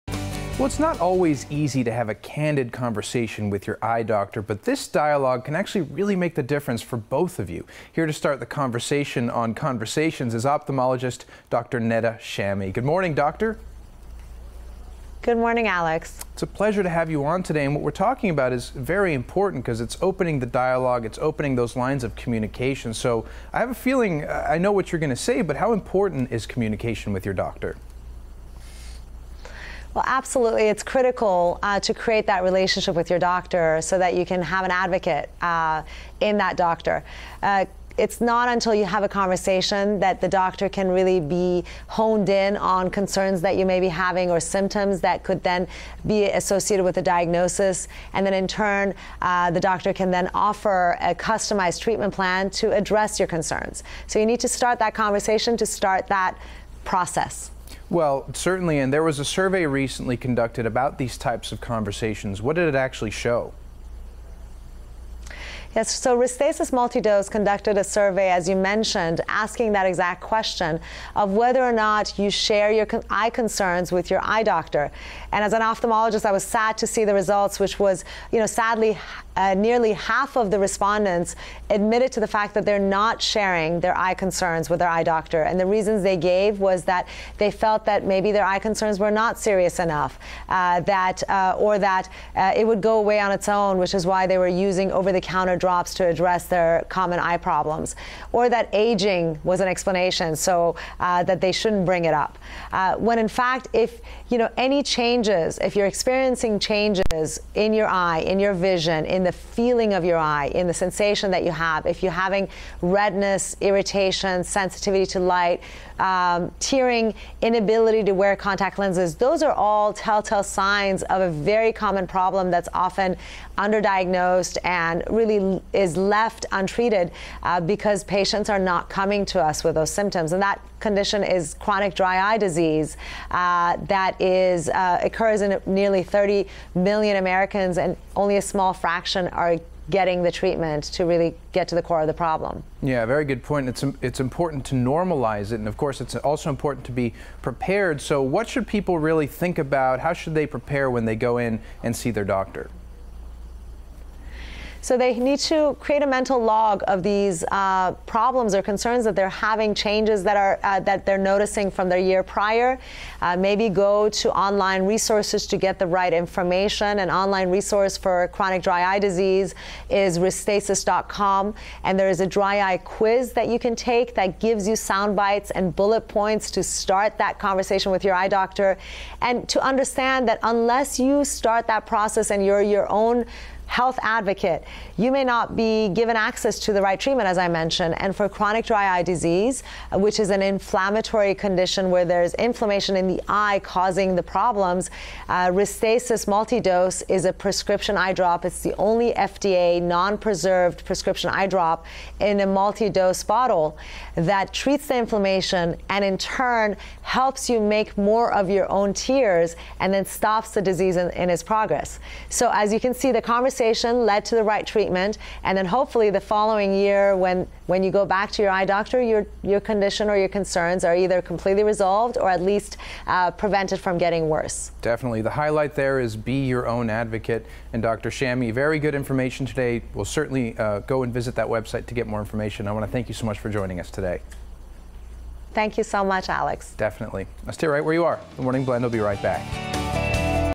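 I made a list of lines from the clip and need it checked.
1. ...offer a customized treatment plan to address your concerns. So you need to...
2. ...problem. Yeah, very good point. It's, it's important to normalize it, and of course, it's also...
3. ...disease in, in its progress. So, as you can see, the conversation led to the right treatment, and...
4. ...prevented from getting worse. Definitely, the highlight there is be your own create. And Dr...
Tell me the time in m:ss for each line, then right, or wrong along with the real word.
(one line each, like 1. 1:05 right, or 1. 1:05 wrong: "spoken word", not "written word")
1. 0:50 right
2. 2:22 right
3. 3:30 right
4. 3:43 wrong: "advocate", not "create".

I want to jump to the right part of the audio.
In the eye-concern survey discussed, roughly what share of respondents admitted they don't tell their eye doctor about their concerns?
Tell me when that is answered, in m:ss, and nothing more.
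1:19.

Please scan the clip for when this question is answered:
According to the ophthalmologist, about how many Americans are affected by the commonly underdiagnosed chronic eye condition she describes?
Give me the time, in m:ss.
2:16.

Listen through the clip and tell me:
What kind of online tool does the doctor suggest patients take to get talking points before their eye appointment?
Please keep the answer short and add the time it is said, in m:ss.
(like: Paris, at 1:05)
dry eye quiz, at 2:52.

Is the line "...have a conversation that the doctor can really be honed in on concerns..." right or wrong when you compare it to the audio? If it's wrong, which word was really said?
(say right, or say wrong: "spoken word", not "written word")
right.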